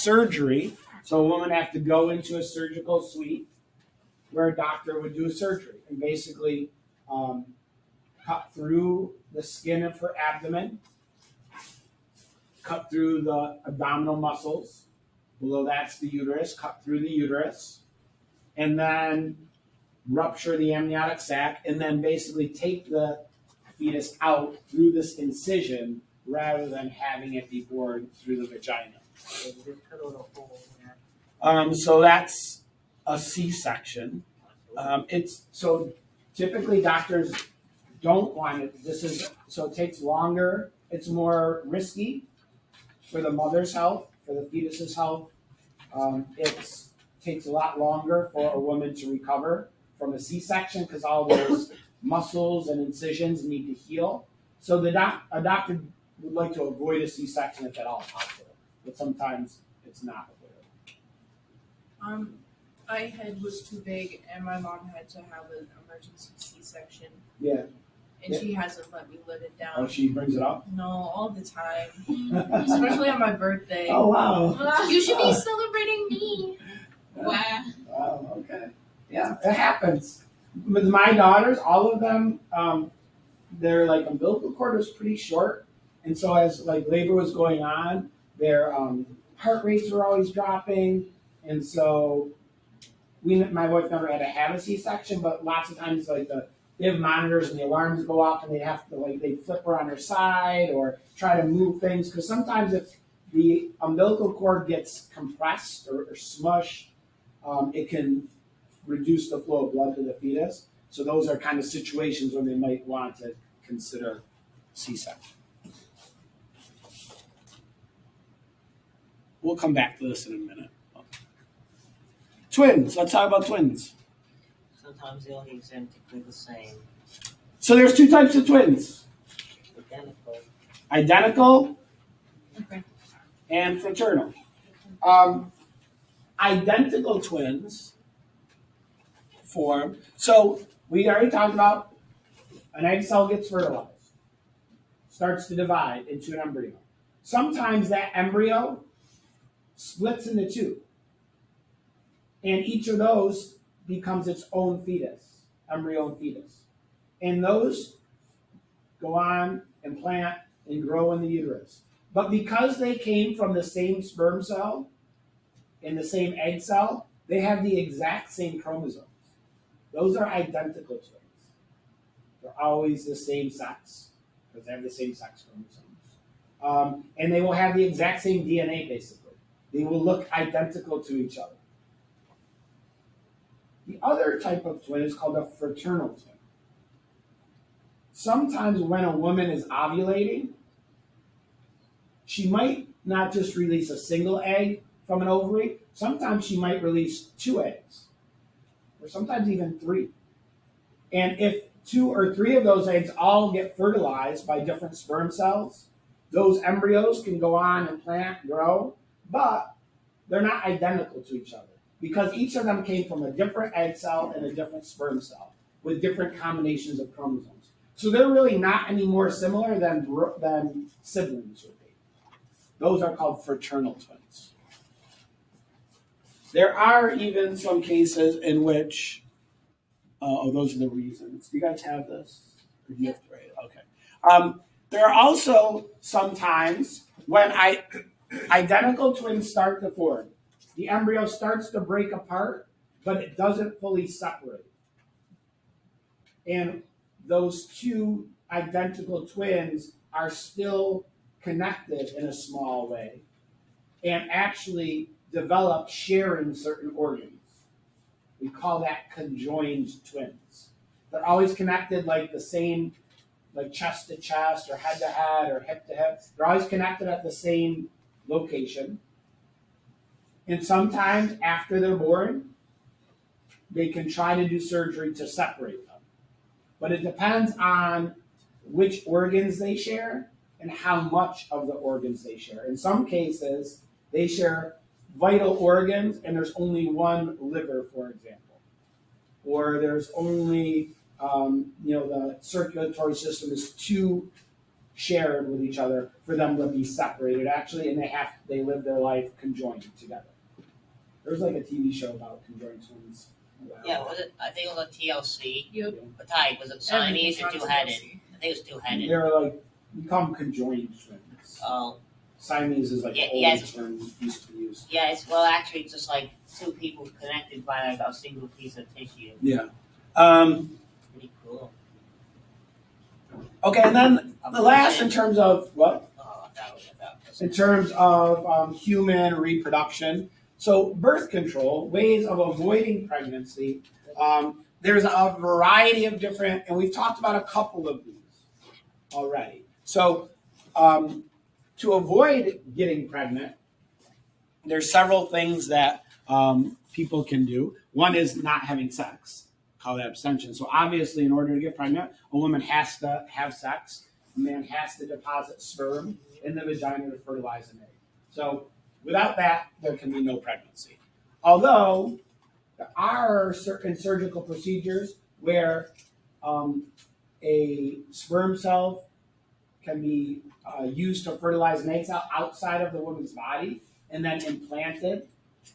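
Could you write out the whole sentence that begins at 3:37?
So they're really not any more similar than, than siblings would be.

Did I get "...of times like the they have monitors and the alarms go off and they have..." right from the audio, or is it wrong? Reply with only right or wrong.
right.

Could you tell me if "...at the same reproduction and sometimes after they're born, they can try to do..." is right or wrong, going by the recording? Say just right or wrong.
wrong.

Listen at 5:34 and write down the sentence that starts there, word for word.
Um, there's a variety of different, and we've talked about a couple of these already.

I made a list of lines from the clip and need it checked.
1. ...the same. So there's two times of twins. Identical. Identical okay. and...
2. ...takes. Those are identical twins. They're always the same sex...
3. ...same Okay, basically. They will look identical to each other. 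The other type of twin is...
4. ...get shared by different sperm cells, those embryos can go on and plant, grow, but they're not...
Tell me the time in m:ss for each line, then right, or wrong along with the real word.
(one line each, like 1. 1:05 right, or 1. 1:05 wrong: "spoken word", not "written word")
1. 2:06 wrong: "types", not "times"
2. 2:48 wrong: "chromosomes", not "takes"
3. 2:58 wrong: "DNA", not "Okay"
4. 3:23 wrong: "fertilized", not "shared".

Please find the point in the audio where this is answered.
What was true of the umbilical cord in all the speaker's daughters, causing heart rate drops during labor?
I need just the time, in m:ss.
1:24.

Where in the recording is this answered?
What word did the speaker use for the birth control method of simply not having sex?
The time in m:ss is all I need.
5:50.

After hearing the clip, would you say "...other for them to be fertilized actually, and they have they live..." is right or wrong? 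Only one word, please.
wrong.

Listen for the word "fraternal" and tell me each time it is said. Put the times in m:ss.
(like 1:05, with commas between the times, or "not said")
2:13, 3:05, 3:43.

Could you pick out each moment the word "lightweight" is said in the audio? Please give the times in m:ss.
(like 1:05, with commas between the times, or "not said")
not said.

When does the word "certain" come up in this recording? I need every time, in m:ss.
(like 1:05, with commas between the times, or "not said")
4:16, 6:03.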